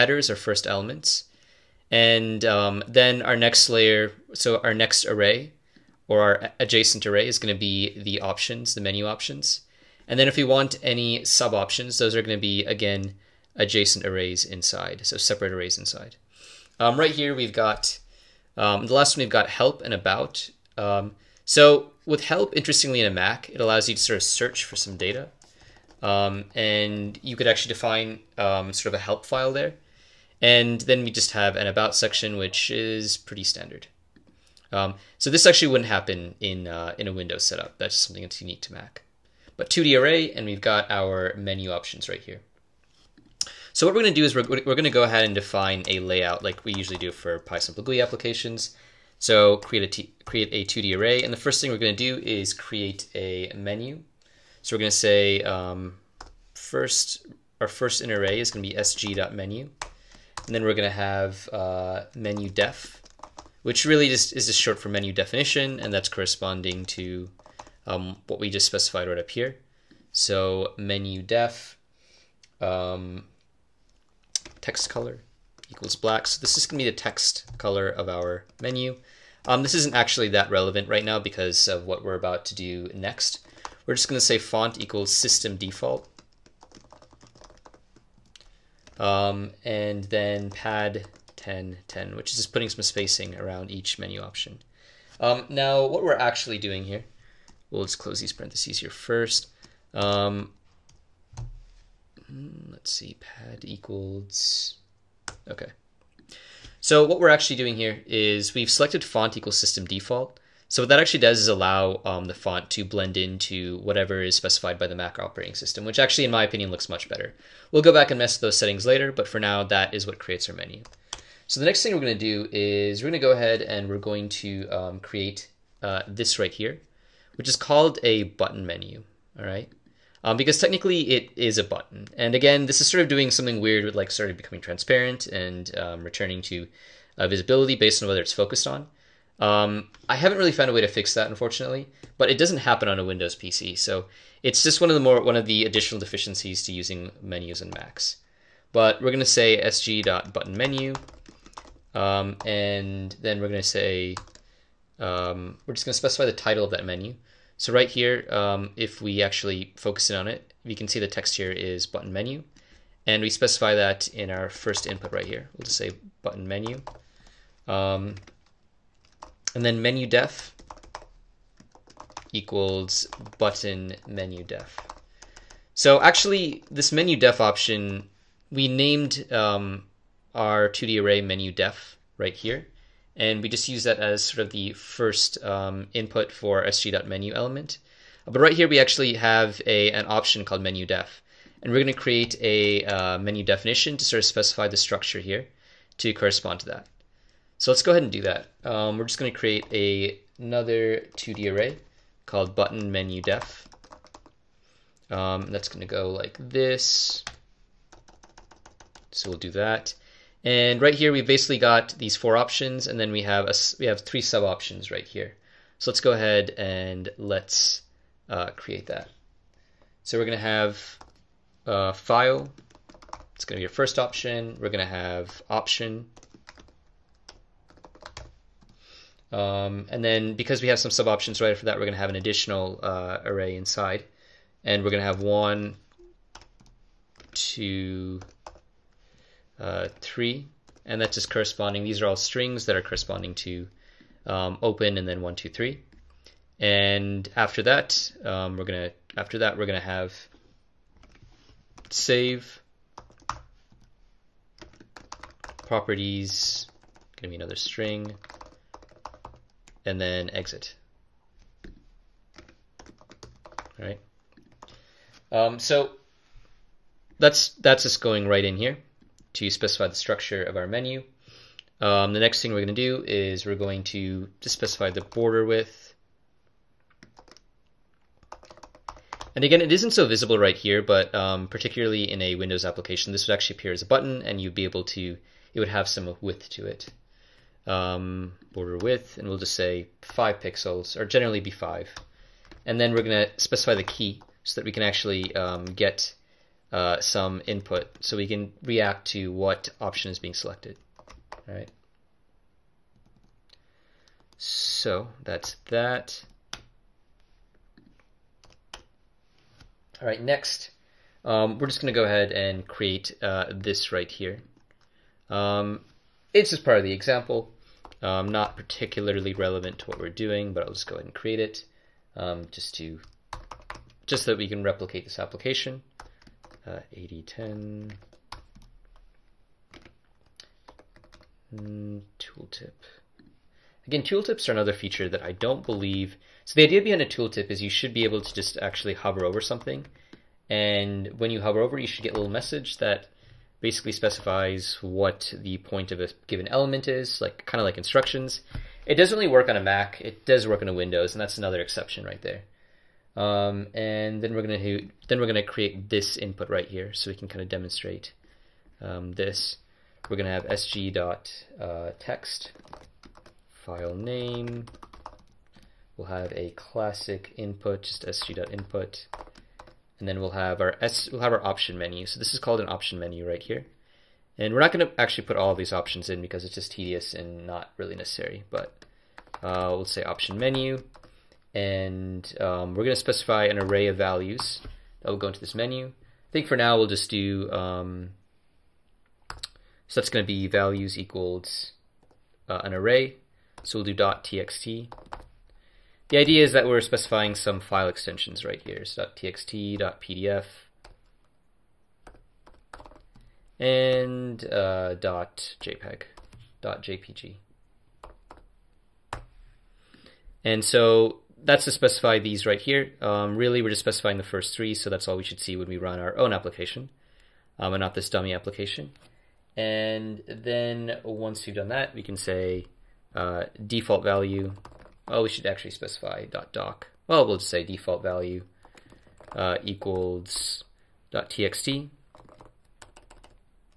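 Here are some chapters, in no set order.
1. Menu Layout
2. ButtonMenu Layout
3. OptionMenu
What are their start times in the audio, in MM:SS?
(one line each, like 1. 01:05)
1. 00:51
2. 02:01
3. 06:11.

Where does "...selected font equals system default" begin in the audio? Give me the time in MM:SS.
01:48.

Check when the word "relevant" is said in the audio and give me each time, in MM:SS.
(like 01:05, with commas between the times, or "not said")
01:20, 05:19.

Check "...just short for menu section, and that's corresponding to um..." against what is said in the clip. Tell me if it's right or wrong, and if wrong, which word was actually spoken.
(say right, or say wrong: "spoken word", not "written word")
wrong: "definition", not "section".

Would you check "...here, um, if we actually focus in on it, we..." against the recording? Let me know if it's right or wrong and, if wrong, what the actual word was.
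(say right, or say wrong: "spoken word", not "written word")
right.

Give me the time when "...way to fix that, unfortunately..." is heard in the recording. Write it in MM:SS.
02:20.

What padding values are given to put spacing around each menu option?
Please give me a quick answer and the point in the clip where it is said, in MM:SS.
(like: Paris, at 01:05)
10, 10, at 01:31.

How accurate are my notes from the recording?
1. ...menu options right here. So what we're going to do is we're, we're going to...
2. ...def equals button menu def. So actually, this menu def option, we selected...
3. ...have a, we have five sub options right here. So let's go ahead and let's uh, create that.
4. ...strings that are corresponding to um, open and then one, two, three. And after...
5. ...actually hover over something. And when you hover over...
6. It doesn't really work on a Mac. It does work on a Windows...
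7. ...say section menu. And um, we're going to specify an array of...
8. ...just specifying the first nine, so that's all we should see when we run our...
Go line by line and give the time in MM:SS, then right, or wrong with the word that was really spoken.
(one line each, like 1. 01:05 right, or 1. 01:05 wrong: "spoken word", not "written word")
1. 00:41 right
2. 02:50 wrong: "named", not "selected"
3. 03:33 wrong: "three", not "five"
4. 04:02 right
5. 05:38 right
6. 05:48 right
7. 06:19 wrong: "option", not "section"
8. 06:53 wrong: "three", not "nine".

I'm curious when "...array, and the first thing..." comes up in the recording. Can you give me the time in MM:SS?
00:50.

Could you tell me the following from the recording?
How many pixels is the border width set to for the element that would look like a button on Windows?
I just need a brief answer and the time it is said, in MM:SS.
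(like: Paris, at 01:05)
5, at 04:50.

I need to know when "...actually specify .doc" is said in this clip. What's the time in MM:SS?
07:05.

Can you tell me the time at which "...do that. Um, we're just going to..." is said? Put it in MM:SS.
03:18.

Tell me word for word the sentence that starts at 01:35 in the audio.
Um, now, what we're actually doing here, we'll just close these parentheses here first.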